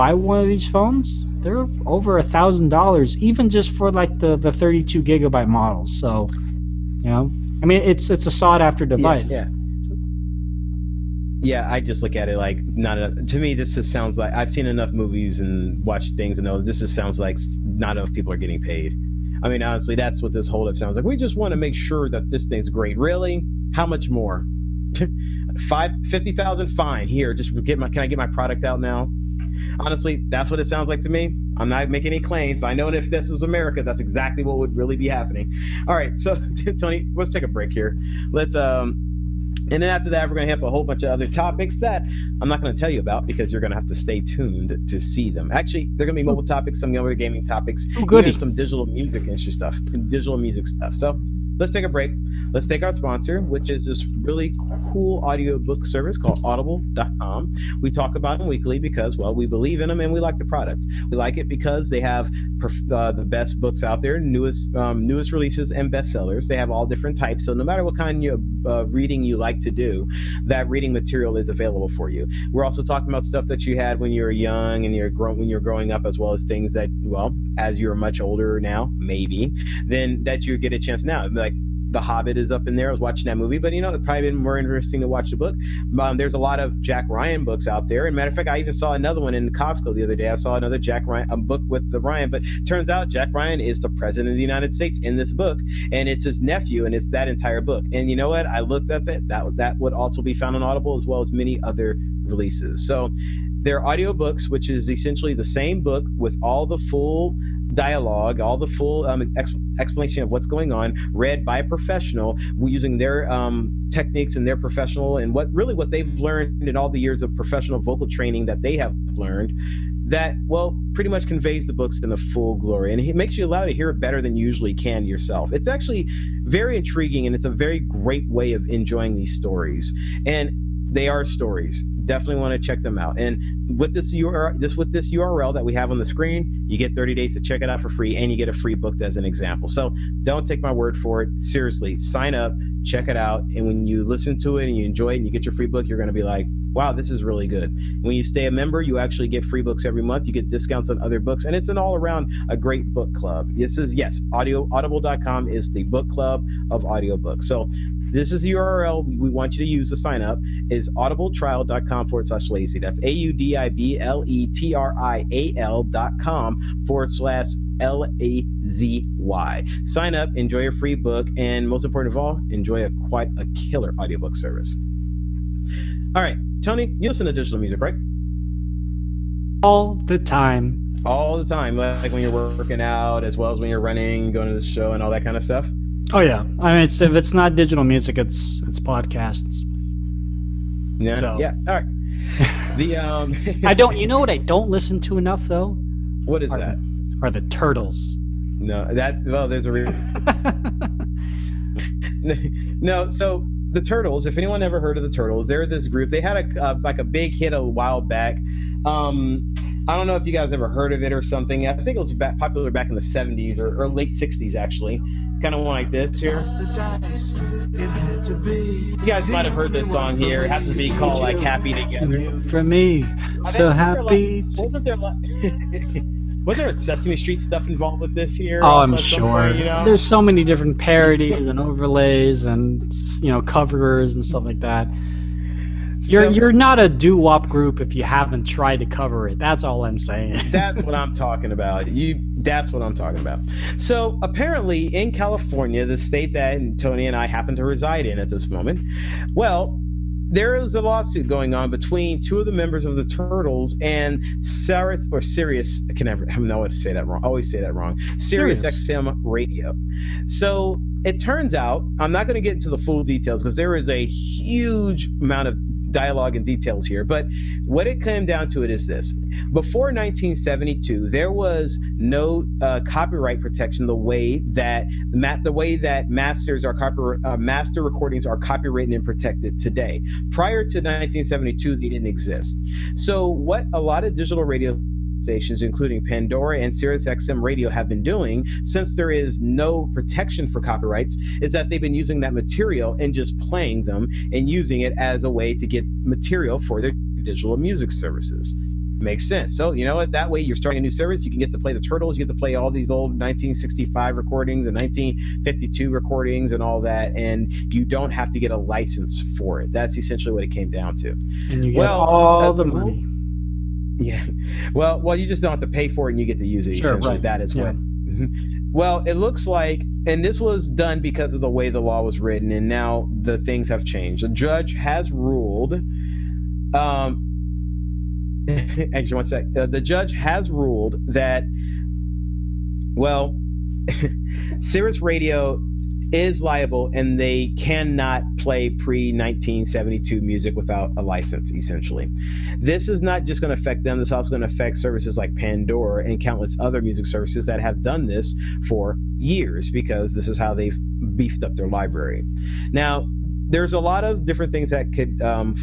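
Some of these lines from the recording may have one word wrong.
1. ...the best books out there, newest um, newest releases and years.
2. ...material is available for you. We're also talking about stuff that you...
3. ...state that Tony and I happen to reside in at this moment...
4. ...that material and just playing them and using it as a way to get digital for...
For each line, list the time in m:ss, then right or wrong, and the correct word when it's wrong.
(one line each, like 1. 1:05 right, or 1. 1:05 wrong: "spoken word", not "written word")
1. 1:03 wrong: "bestsellers", not "years"
2. 1:10 right
3. 4:05 right
4. 4:52 wrong: "material", not "digital".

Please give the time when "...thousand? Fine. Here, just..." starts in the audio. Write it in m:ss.
0:26.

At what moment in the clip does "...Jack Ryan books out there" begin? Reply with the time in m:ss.
1:26.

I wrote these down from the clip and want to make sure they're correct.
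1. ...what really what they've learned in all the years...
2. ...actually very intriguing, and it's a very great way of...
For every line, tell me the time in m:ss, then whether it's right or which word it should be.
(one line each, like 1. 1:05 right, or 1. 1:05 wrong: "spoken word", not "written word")
1. 1:55 right
2. 2:05 right.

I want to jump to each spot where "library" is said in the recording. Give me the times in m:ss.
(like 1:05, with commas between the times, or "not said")
5:51.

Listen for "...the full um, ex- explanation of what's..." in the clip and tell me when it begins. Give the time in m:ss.
1:48.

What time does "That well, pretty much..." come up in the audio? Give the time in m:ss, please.
2:00.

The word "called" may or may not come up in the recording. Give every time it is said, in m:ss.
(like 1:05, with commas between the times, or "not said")
0:56, 3:40.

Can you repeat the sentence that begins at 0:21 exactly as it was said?
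We just want to make sure that this thing's great.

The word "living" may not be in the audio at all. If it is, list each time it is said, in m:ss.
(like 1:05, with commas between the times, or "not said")
not said.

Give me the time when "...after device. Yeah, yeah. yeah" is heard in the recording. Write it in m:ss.
0:08.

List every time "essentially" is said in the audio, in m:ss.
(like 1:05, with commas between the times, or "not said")
1:44, 5:09, 5:16, 5:41.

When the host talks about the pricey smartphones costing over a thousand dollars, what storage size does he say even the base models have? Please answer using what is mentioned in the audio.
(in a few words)
32 gigabytes.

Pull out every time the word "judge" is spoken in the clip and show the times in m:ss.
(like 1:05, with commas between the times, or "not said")
5:24, 5:29.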